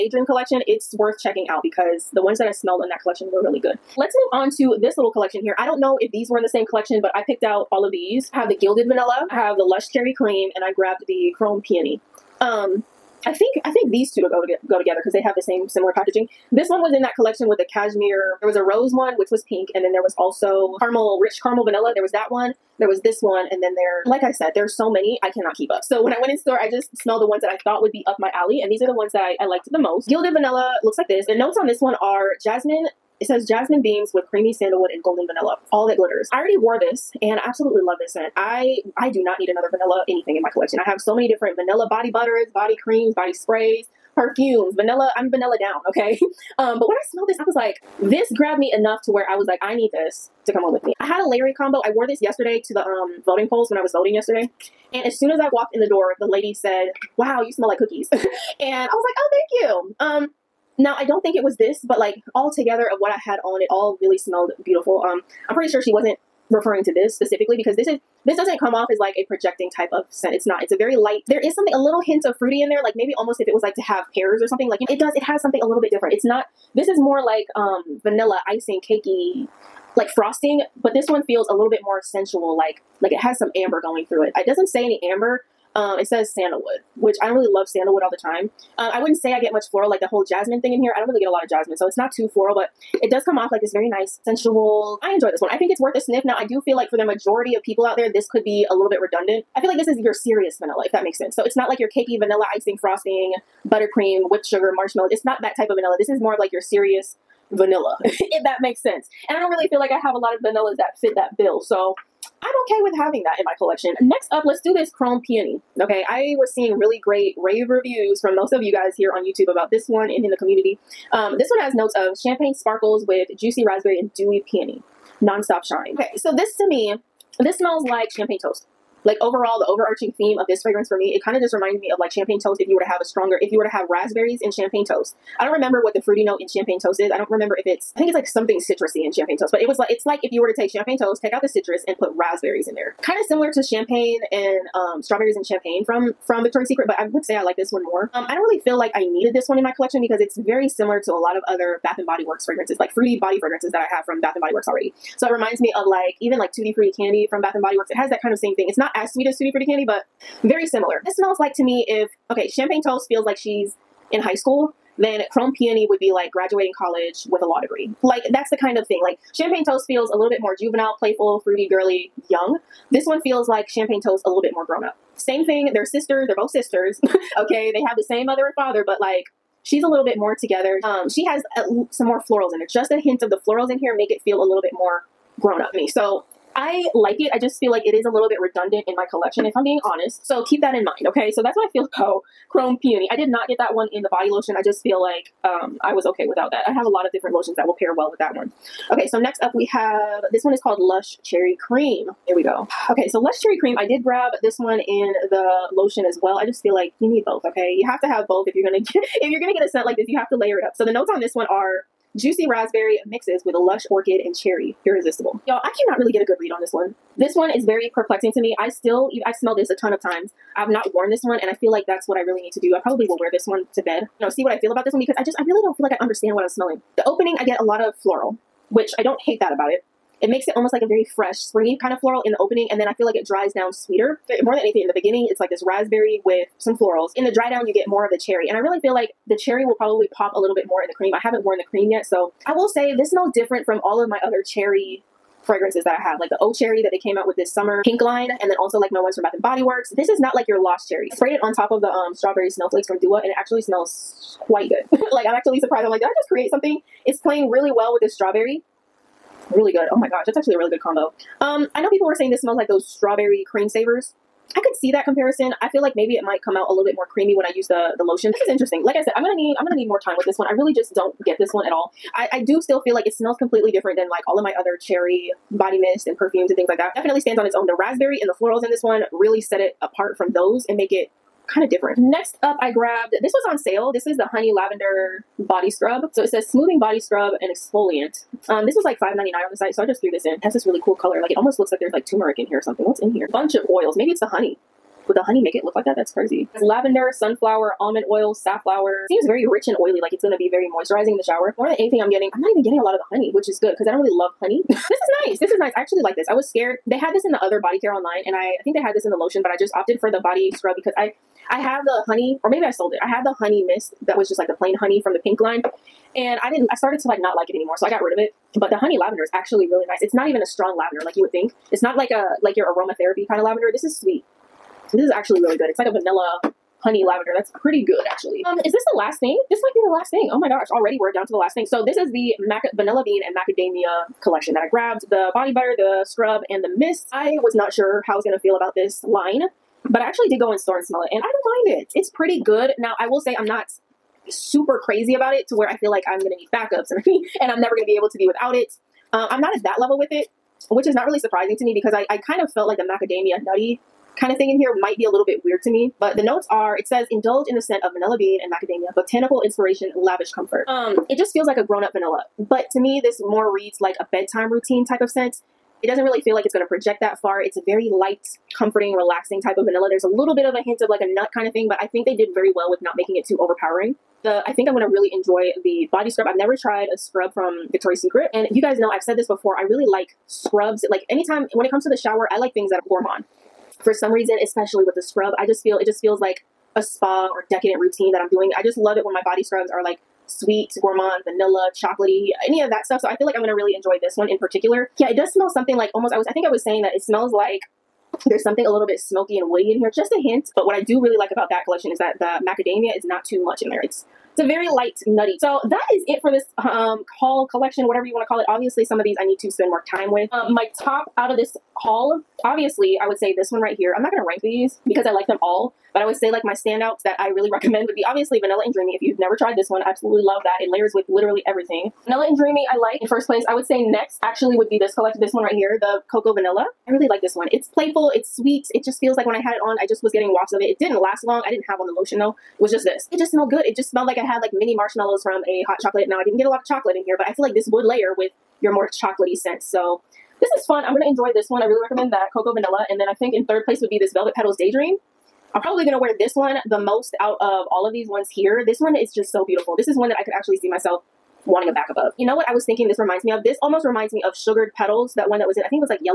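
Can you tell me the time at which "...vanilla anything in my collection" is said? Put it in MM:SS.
00:39.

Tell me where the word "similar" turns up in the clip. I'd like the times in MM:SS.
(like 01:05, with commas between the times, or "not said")
00:15, 02:23, 02:30, 02:40.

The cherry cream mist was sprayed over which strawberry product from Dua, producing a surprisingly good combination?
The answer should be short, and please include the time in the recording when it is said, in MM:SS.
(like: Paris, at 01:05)
strawberry snowflakes, at 04:12.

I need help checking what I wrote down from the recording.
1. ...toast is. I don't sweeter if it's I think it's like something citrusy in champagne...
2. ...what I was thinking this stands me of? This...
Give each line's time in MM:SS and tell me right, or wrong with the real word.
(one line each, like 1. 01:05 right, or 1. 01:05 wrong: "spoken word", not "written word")
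1. 02:16 wrong: "remember", not "sweeter"
2. 07:32 wrong: "reminds", not "stands".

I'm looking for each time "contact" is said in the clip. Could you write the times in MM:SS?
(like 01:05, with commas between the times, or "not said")
not said.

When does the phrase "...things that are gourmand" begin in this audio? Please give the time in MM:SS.
06:22.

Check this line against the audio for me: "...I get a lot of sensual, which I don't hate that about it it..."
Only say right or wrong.
wrong.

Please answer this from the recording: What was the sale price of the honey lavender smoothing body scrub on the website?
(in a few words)
$5.99.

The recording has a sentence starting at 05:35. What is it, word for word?
The body butter, the scrub, and the mist.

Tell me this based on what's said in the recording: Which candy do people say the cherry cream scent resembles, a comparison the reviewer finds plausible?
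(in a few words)
strawberry cream savers.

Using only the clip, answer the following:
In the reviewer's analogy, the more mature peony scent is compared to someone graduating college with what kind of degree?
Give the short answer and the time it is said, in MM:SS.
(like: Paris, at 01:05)
a law degree, at 02:47.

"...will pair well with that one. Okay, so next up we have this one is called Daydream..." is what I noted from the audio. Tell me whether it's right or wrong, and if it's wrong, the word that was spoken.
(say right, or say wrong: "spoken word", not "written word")
wrong: "Lush", not "Daydream".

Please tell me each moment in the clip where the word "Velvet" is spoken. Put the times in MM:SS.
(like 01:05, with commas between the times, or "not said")
07:24.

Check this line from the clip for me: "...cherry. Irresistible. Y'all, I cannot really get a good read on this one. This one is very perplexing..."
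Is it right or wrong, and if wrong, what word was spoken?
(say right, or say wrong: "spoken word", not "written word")
right.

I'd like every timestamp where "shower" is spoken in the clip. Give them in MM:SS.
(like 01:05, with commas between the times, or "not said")
05:01, 06:21.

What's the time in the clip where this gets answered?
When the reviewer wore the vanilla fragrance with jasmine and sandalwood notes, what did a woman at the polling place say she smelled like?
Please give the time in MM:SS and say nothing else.
00:57.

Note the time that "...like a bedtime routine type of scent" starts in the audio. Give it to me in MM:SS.
06:03.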